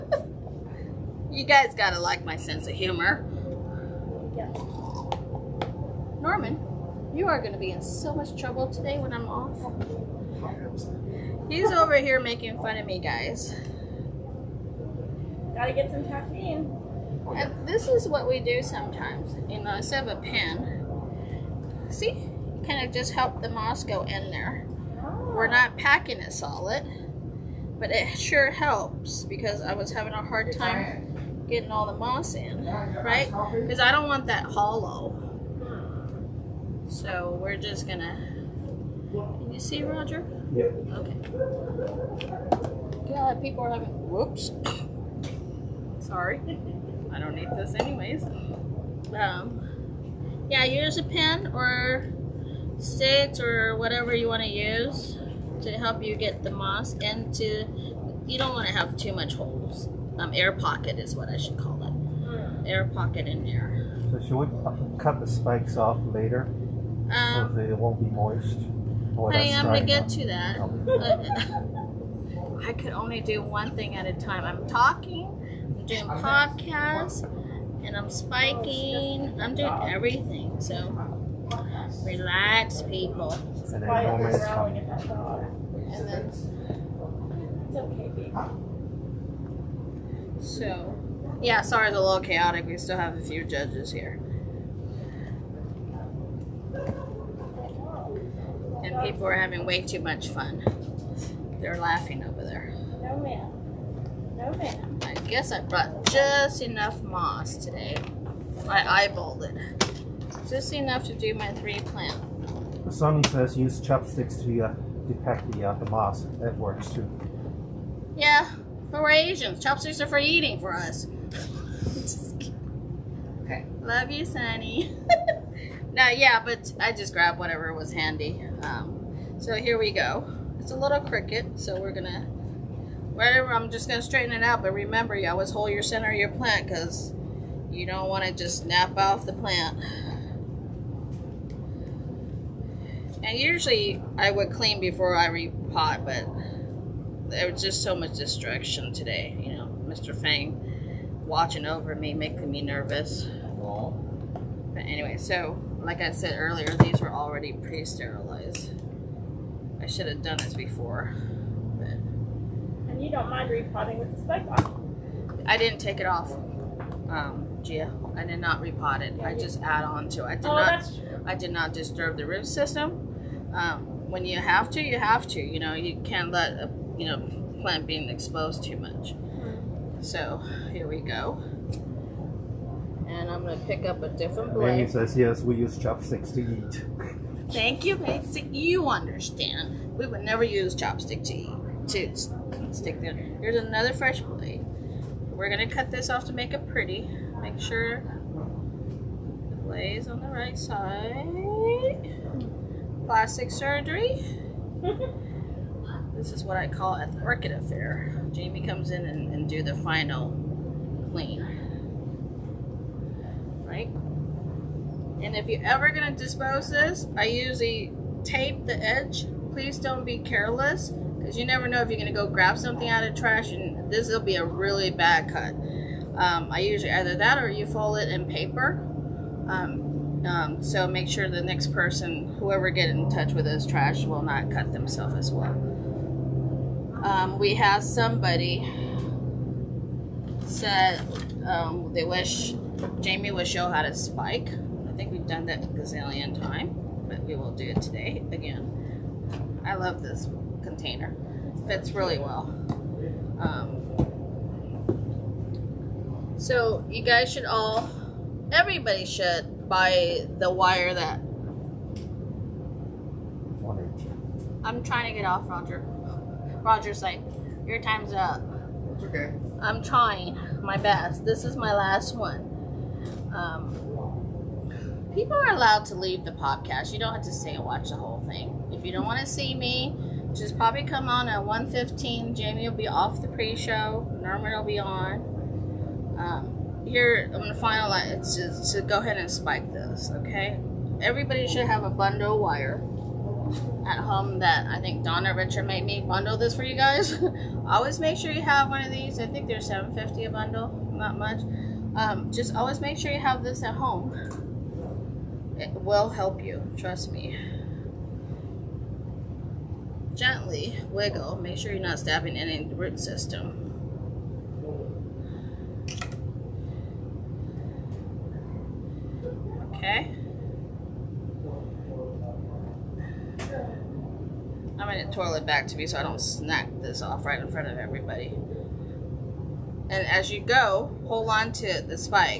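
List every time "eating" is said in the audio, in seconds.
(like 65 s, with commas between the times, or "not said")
120 s.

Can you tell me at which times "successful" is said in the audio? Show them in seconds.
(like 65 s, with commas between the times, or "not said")
not said.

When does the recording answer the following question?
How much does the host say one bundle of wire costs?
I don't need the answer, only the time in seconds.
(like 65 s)
299 s.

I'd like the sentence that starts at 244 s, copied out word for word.
I think we've done that gazillion time, but we will do it today again.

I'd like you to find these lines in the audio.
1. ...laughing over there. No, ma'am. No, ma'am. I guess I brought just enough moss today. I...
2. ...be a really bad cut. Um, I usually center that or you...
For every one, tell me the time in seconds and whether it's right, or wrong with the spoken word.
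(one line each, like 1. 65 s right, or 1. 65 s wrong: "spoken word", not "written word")
1. 101 s right
2. 224 s wrong: "either", not "center".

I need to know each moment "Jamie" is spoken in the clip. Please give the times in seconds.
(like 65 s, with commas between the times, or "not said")
208 s, 243 s, 282 s.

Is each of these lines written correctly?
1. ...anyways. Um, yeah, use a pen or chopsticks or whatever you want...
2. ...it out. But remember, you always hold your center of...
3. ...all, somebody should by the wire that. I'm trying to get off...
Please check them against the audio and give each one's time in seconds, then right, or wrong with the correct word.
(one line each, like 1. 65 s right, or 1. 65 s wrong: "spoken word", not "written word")
1. 47 s wrong: "sticks", not "chopsticks"
2. 134 s right
3. 257 s wrong: "everybody", not "somebody".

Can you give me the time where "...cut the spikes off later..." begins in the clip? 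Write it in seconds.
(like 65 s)
64 s.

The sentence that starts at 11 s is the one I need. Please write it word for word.
He's over here making fun of me, guys.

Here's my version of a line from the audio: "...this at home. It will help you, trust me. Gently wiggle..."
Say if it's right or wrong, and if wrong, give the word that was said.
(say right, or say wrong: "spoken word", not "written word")
right.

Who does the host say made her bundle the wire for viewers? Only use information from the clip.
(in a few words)
Donna Richard.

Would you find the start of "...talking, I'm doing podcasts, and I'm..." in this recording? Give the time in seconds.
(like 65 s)
74 s.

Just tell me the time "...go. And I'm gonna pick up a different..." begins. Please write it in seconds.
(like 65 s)
181 s.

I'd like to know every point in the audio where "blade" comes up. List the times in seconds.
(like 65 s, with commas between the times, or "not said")
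184 s, 194 s, 199 s.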